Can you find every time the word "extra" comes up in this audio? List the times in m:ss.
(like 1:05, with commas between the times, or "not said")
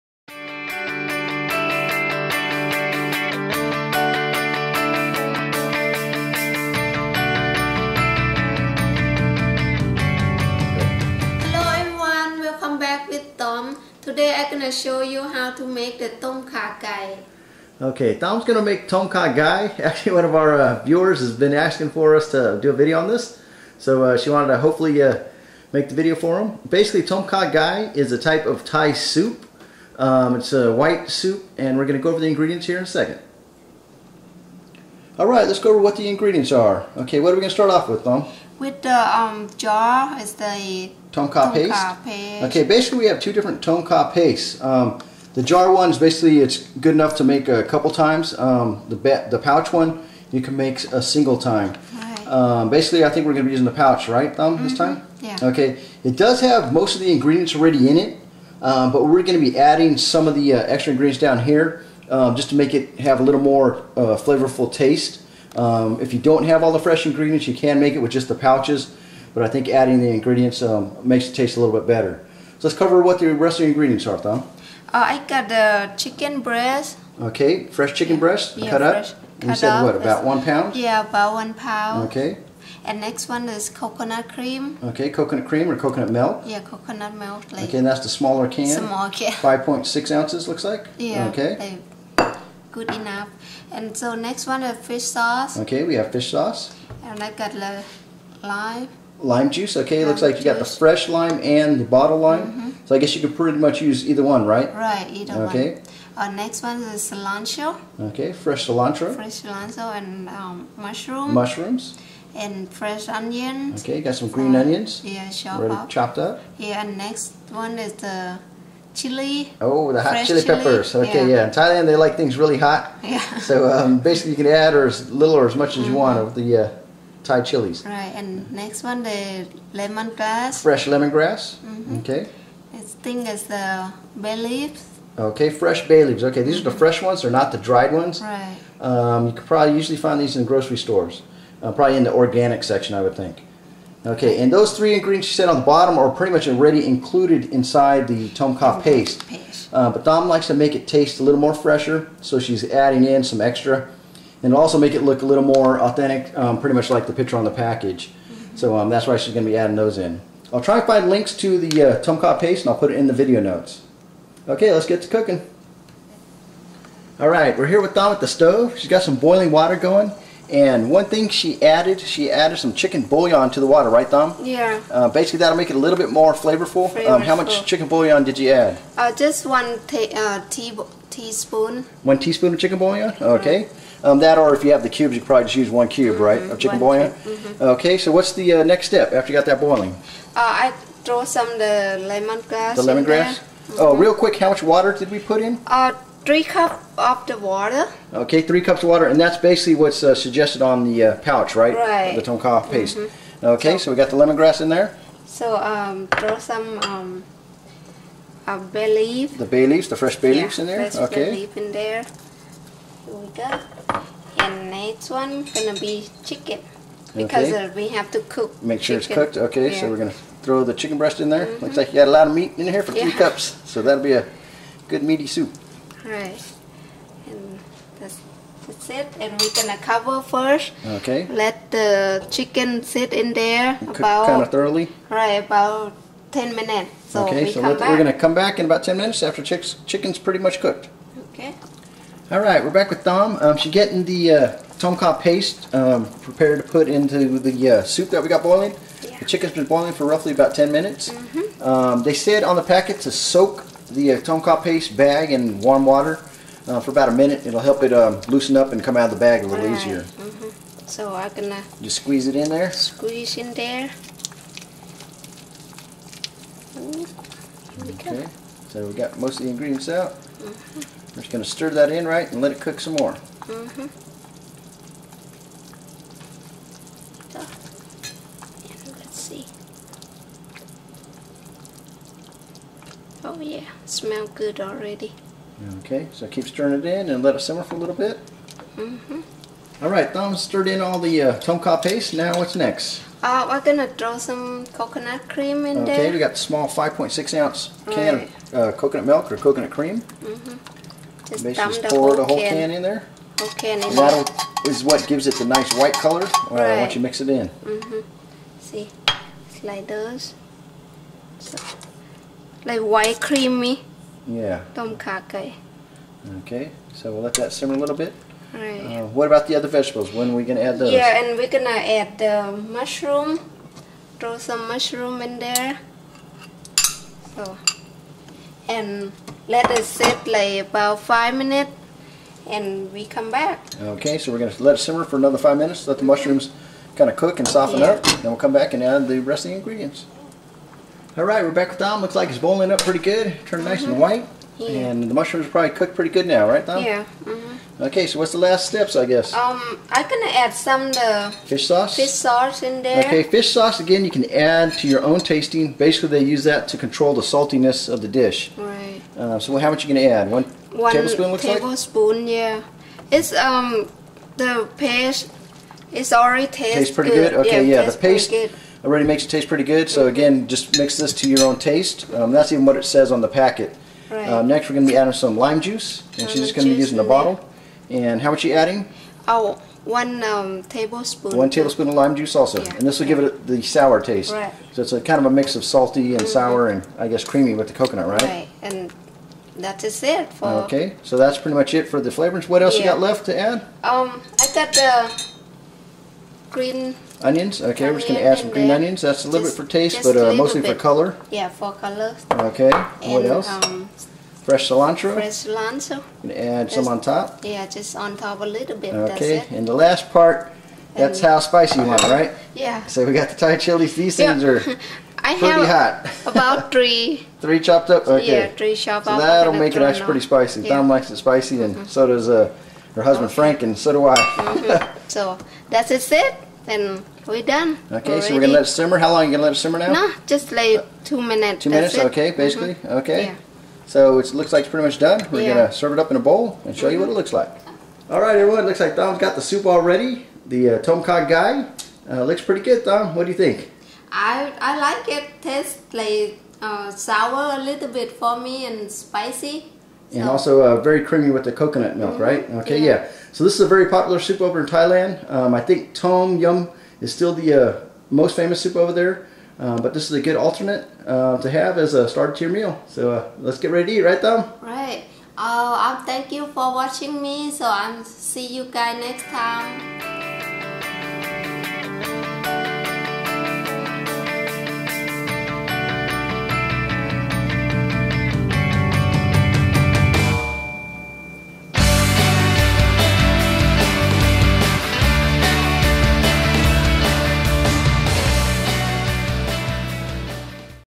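1:00, 2:33.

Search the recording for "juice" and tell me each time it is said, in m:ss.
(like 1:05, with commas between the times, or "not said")
1:39, 6:15, 6:22.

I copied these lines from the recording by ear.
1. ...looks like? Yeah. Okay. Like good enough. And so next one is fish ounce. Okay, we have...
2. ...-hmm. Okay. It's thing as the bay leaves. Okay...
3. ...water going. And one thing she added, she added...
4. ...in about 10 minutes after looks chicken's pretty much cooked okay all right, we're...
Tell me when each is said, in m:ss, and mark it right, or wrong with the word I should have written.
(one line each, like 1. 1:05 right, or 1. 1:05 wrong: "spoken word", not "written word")
1. 1:30 wrong: "sauce", not "ounce"
2. 2:11 right
3. 2:49 right
4. 3:58 wrong: "chicks", not "looks".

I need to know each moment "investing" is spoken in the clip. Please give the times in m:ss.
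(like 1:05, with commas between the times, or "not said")
not said.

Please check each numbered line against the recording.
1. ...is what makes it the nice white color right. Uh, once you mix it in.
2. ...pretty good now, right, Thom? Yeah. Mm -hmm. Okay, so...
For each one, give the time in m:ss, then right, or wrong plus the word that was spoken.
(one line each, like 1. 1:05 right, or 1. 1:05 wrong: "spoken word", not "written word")
1. 5:04 wrong: "gives", not "makes"
2. 5:45 right.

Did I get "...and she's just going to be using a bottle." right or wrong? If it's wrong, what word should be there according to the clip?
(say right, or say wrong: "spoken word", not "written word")
right.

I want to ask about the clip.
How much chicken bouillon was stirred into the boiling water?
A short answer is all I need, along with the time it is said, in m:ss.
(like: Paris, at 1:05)
One teaspoon, at 3:02.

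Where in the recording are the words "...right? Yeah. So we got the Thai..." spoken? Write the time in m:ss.
6:52.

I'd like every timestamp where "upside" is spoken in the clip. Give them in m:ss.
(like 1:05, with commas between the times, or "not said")
not said.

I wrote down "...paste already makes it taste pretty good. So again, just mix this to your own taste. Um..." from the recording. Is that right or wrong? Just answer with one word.
right.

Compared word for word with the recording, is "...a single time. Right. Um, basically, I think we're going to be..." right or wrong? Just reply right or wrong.
right.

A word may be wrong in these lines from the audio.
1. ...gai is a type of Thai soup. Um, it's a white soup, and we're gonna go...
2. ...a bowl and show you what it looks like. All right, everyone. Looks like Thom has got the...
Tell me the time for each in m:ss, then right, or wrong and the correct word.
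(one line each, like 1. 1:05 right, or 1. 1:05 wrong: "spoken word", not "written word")
1. 0:27 right
2. 7:16 right.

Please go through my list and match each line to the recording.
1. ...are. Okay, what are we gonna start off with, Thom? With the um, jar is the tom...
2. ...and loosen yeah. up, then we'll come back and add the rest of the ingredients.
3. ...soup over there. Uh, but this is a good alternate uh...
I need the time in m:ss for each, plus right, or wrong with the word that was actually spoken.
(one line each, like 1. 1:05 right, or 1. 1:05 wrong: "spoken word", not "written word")
1. 0:36 right
2. 5:37 wrong: "soften", not "loosen"
3. 7:38 right.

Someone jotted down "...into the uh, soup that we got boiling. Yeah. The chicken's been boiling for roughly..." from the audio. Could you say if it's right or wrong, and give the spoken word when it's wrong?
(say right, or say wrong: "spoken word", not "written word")
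right.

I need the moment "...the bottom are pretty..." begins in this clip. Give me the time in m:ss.
2:25.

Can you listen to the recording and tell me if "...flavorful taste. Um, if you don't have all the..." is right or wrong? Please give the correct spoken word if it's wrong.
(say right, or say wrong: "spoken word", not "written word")
right.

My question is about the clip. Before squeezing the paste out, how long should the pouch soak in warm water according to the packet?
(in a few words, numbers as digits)
About a minute.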